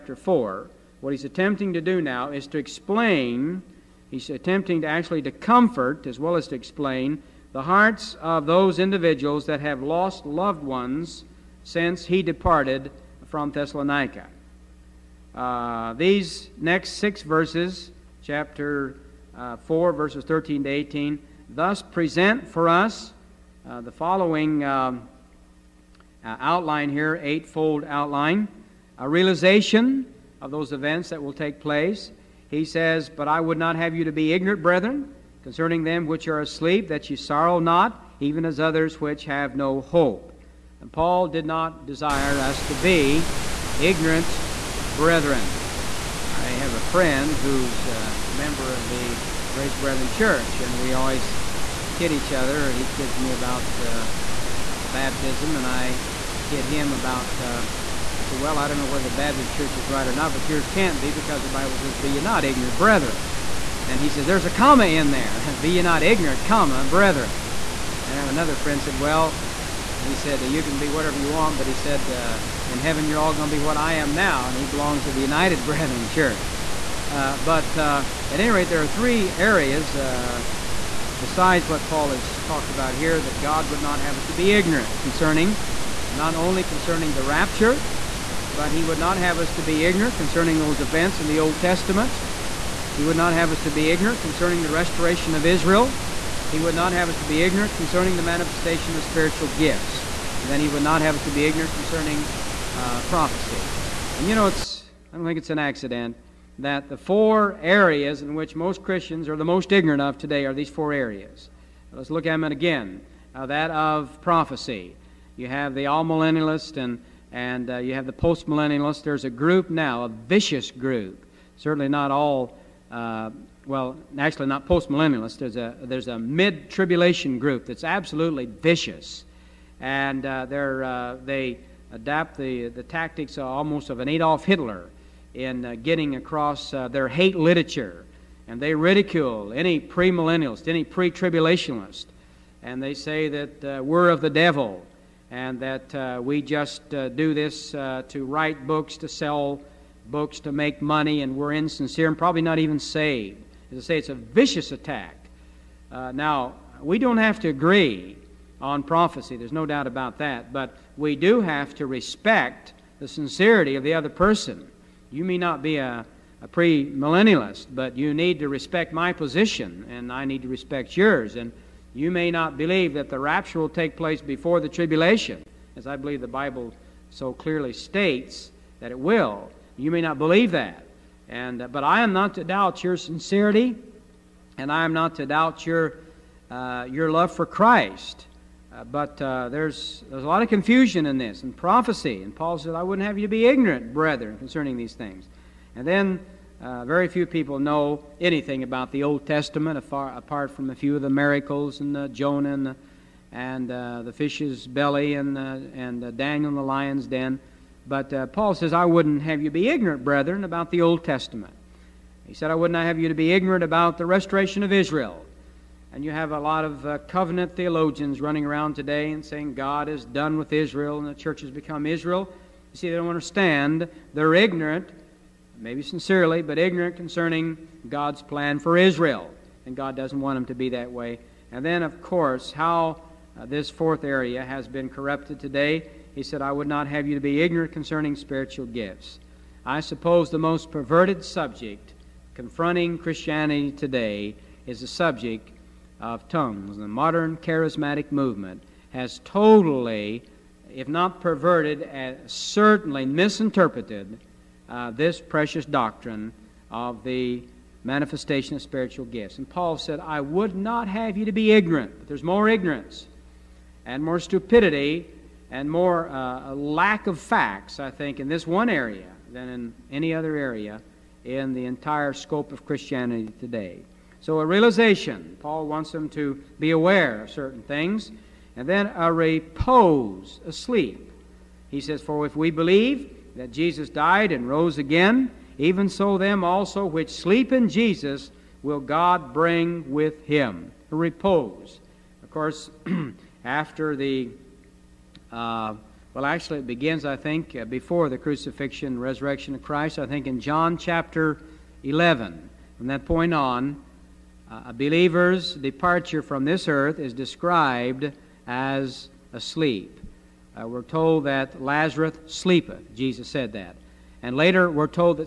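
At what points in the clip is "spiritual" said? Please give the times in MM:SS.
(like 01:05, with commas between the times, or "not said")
01:39, 03:58, 04:18.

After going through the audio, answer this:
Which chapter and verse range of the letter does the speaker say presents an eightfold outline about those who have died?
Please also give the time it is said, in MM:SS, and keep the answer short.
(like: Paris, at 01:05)
Chapter 4, verses 13 to 18, at 00:18.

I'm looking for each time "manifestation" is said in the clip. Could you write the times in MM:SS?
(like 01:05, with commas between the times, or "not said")
01:38, 04:17.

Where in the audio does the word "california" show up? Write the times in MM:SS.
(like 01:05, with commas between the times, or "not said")
not said.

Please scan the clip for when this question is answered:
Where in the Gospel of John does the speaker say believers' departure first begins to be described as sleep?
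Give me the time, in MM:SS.
05:00.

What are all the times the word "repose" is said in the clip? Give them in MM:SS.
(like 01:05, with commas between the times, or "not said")
04:39, 04:50.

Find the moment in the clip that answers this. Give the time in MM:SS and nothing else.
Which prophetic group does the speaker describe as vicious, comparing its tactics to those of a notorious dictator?
02:06.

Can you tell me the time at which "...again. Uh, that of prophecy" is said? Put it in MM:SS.
01:52.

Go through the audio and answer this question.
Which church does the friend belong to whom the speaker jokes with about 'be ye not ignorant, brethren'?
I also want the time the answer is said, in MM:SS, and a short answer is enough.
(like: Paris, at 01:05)
Grace Brethren Church, at 00:49.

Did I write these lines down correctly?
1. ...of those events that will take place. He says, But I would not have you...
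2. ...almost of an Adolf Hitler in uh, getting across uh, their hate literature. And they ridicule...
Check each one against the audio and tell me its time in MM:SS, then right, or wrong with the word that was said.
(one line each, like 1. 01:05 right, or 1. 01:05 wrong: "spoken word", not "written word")
1. 00:30 right
2. 02:13 right.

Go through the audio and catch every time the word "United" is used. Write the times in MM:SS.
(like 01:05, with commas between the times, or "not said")
01:15.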